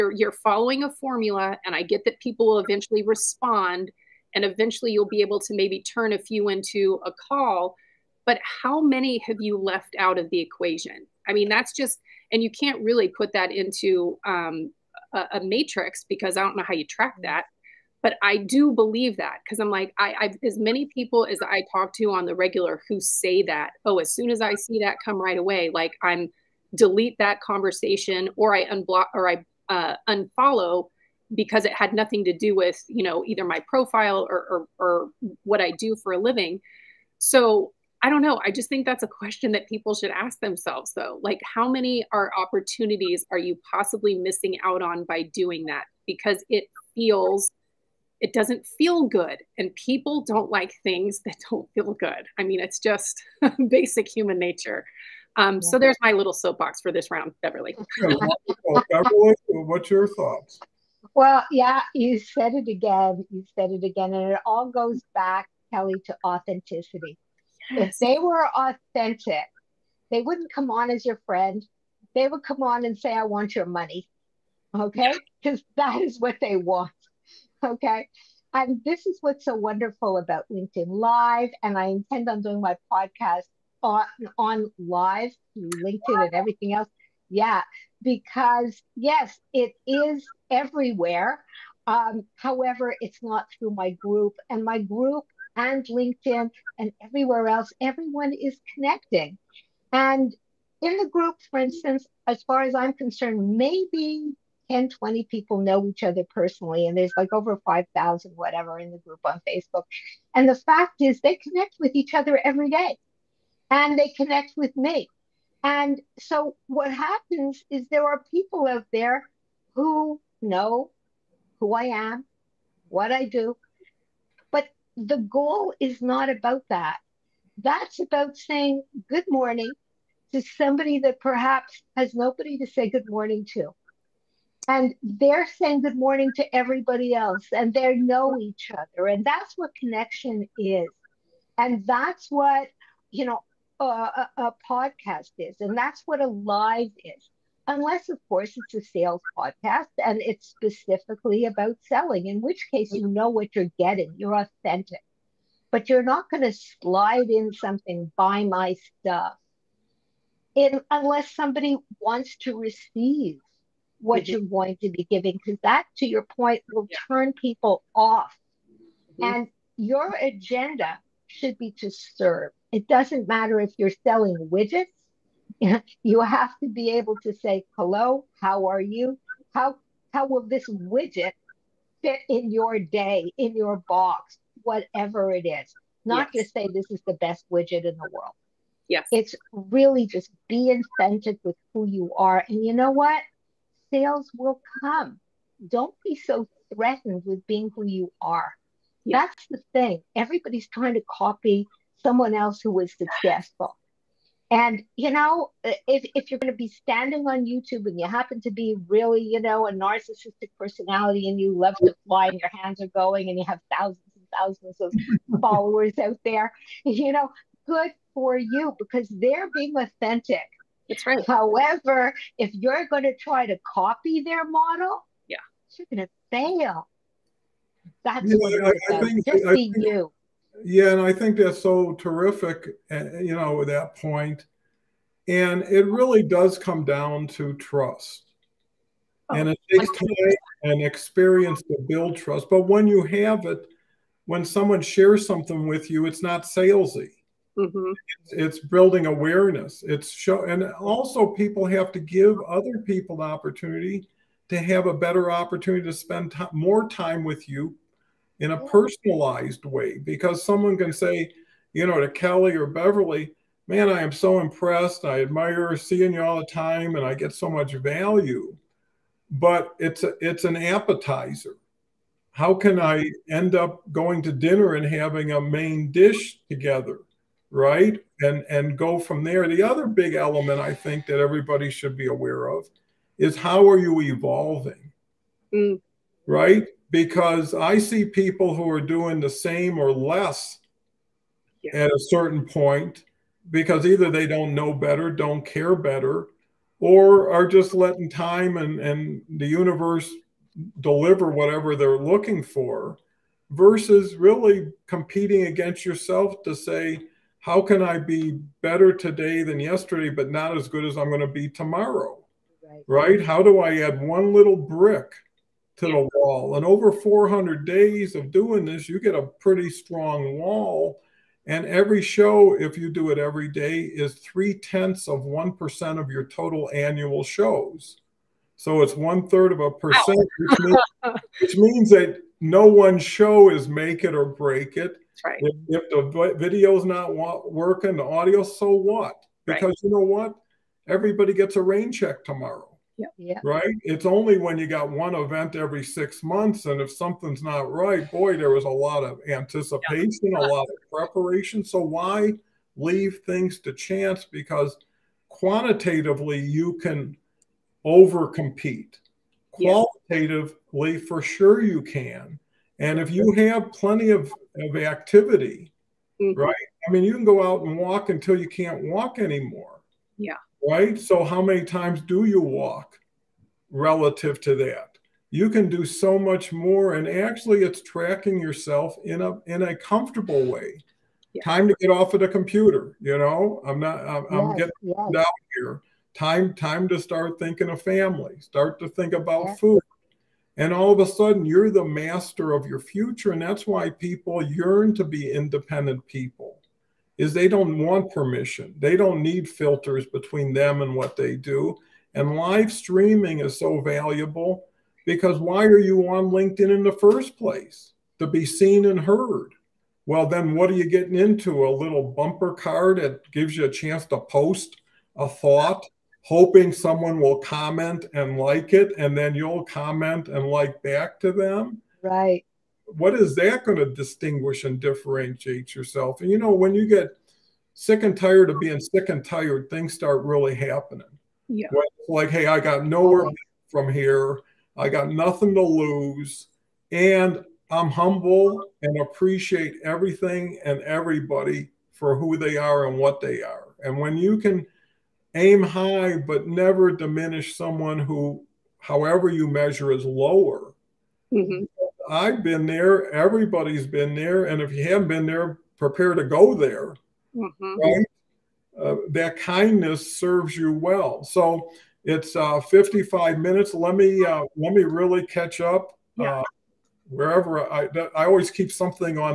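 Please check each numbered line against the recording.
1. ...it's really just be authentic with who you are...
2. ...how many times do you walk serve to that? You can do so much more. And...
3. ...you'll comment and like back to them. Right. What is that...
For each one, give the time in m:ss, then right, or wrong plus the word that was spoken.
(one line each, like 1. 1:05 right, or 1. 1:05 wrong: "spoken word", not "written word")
1. 3:09 right
2. 6:11 wrong: "relative", not "serve"
3. 6:59 right.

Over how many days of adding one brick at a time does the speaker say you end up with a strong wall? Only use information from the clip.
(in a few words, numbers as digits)
400.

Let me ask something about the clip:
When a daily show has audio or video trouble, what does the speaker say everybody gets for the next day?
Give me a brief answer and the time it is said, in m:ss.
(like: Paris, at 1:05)
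a rain check, at 5:41.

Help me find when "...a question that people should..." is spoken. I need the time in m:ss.
0:39.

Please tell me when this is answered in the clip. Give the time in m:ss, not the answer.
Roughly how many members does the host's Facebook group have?
1:47.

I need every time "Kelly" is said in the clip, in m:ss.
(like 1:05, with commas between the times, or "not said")
1:05, 4:22.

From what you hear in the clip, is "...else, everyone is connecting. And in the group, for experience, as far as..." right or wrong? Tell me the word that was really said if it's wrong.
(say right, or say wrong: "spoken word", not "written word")
wrong: "instance", not "experience".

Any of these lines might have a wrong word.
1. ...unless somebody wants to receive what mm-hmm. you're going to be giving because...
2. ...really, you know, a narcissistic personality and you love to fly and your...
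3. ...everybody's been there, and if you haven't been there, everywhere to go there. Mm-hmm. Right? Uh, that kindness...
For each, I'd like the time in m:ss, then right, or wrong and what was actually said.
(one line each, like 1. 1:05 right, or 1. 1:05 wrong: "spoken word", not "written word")
1. 2:40 right
2. 3:28 right
3. 7:33 wrong: "prepare", not "everywhere".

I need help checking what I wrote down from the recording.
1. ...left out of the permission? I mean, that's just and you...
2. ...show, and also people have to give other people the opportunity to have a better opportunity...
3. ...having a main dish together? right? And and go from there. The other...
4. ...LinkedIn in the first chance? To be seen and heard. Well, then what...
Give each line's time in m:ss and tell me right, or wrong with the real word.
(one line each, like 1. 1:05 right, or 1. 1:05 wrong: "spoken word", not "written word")
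1. 0:09 wrong: "equation", not "permission"
2. 4:10 right
3. 4:34 right
4. 6:46 wrong: "place", not "chance".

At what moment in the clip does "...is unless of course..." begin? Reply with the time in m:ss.
2:27.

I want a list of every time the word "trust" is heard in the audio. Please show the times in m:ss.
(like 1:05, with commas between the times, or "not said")
3:57, 4:02.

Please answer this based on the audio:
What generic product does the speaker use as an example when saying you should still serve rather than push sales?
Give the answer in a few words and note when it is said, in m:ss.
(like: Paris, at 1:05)
widgets, at 2:54.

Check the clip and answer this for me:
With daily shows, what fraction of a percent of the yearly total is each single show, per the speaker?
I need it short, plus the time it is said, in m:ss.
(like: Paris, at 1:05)
one third, at 5:28.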